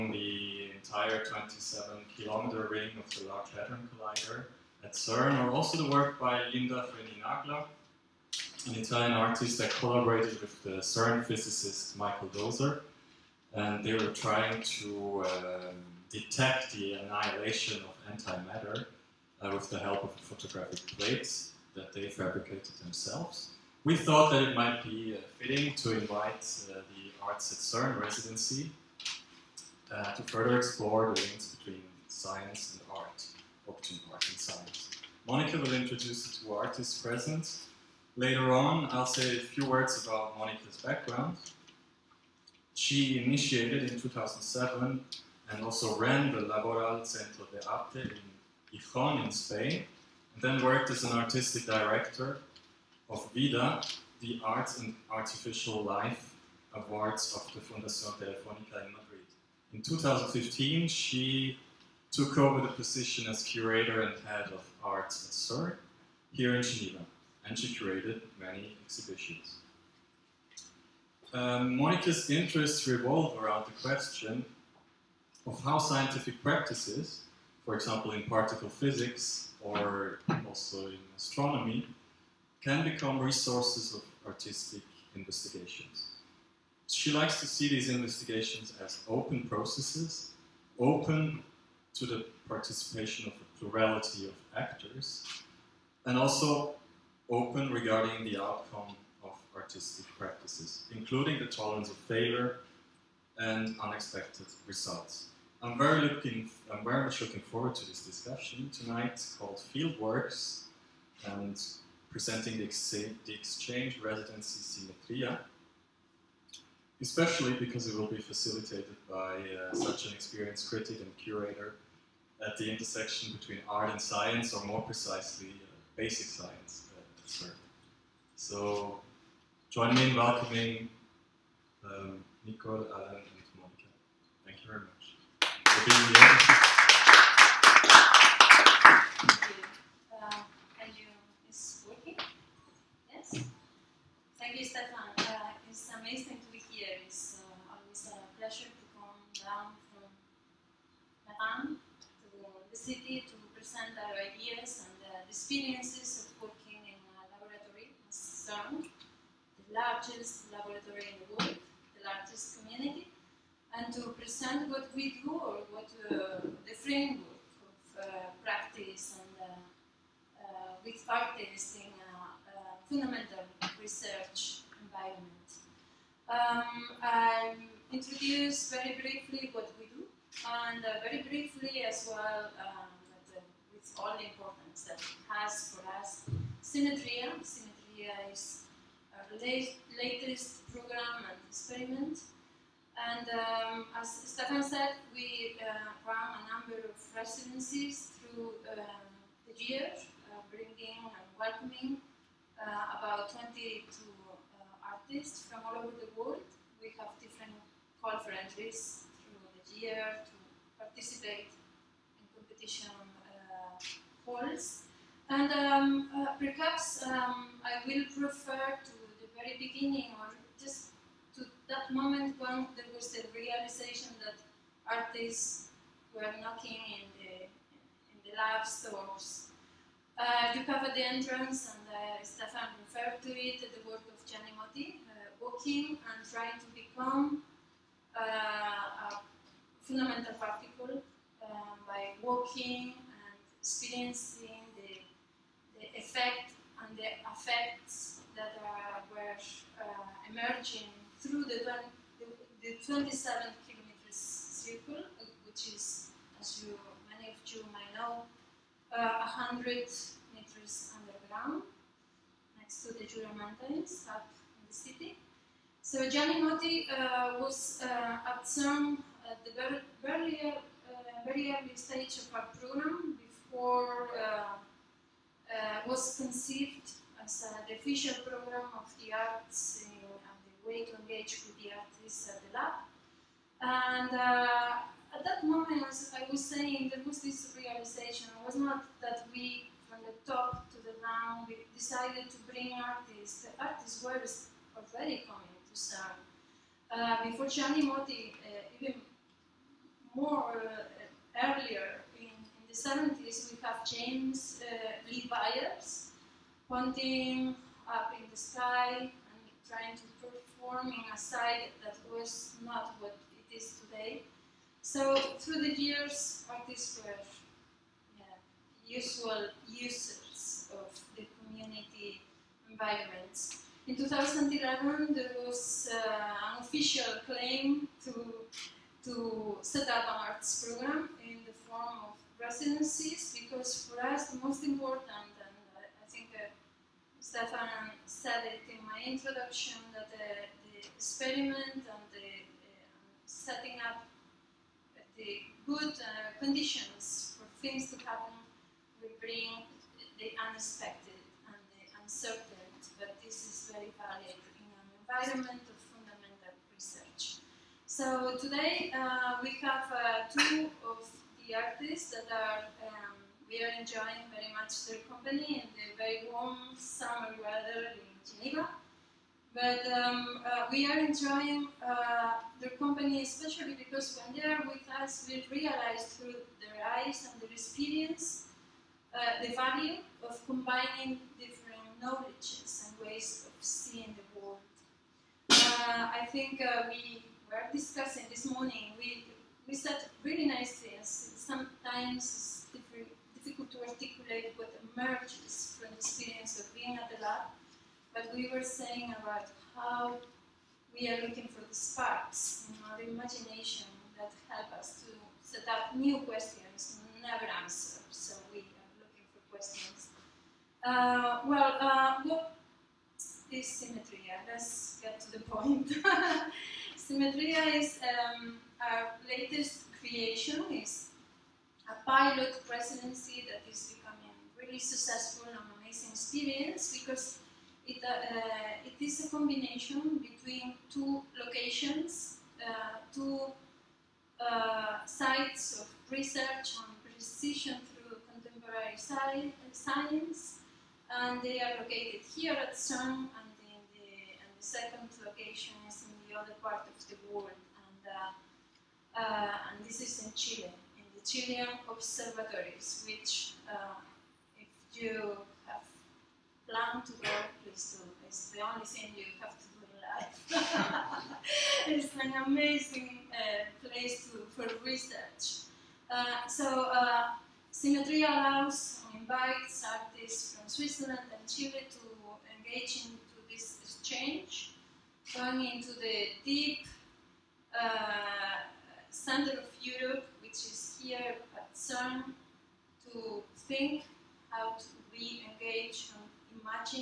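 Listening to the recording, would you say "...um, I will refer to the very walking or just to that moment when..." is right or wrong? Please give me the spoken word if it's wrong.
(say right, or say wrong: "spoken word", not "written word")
wrong: "beginning", not "walking".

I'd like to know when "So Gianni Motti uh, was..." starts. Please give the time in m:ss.
4:25.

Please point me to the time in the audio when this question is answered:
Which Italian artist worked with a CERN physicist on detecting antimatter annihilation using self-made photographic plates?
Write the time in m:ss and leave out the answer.
0:06.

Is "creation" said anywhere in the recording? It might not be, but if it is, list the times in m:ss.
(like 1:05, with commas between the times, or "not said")
6:59.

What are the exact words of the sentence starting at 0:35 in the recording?
Monica will introduce the two artists present.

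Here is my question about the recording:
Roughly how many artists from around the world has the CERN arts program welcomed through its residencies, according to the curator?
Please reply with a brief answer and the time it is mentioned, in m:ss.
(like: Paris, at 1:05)
22, at 3:23.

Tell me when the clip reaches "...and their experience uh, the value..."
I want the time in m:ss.
6:17.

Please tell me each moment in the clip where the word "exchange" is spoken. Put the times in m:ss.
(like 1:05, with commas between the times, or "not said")
1:53, 7:53.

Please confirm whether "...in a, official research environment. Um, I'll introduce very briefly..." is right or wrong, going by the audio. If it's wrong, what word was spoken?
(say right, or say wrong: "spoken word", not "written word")
wrong: "fundamental", not "official".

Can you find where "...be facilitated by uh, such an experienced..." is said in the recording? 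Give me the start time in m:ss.
1:58.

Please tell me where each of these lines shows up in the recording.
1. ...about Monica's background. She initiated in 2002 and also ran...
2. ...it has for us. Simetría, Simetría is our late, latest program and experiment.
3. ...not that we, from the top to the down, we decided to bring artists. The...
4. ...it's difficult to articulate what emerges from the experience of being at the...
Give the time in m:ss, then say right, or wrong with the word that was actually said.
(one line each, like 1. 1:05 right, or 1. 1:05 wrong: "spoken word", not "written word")
1. 0:40 wrong: "2007", not "2002"
2. 3:05 right
3. 4:48 right
4. 6:32 right.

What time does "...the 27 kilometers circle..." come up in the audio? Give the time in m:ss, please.
4:12.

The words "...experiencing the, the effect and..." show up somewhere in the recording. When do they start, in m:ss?
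4:03.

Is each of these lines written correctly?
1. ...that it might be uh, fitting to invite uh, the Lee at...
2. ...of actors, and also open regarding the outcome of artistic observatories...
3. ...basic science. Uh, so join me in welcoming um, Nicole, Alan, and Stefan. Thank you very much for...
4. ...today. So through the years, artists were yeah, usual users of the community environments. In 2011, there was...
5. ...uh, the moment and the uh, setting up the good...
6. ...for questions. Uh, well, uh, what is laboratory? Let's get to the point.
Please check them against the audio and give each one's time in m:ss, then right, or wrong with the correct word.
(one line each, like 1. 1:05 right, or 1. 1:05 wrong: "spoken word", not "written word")
1. 0:24 wrong: "Arts", not "Lee"
2. 1:34 wrong: "practices", not "observatories"
3. 2:05 wrong: "Monica", not "Stefan"
4. 5:13 right
5. 5:40 wrong: "experiment", not "moment"
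6. 6:49 wrong: "symmetry", not "laboratory".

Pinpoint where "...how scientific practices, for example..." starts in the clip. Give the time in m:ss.
1:15.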